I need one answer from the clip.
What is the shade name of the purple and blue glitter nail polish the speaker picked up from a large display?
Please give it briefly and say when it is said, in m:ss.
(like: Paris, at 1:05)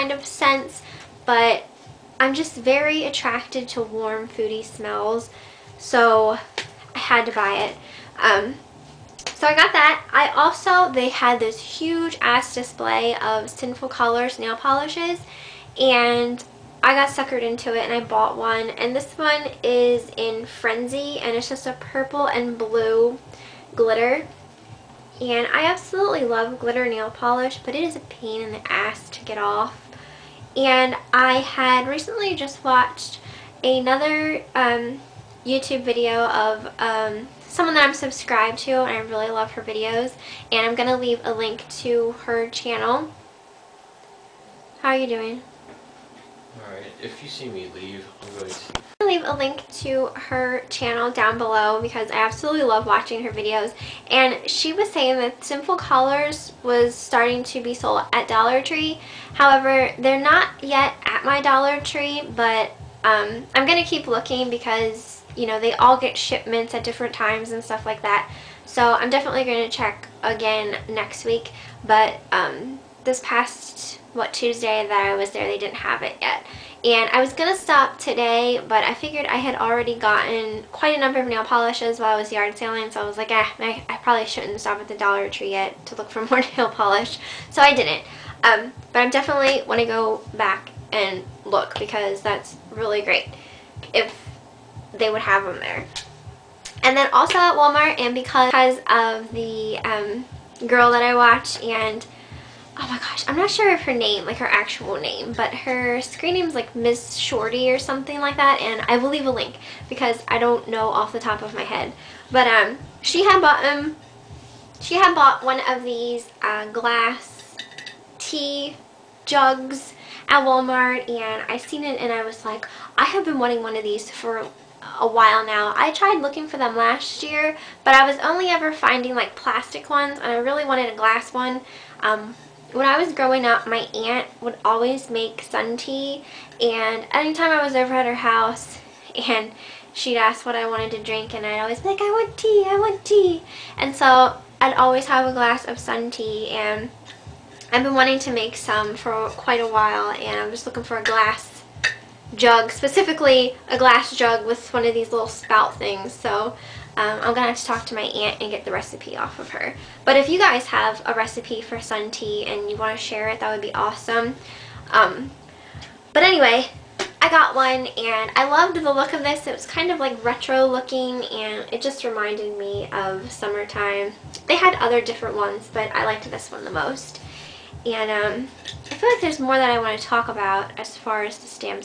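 Frenzy, at 0:20.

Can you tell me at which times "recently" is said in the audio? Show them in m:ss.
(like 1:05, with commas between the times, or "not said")
0:31.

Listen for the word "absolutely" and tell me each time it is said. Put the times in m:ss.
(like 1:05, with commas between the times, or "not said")
0:25, 0:52.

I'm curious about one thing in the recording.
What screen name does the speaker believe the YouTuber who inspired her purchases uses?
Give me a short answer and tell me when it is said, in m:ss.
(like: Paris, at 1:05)
Miss Shorty, at 1:46.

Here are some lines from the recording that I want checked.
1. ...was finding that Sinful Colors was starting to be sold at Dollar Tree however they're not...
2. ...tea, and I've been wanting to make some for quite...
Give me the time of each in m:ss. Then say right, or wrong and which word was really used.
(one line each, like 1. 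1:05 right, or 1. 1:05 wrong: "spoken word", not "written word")
1. 0:54 wrong: "saying", not "finding"
2. 2:26 right.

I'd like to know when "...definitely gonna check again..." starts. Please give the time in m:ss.
1:09.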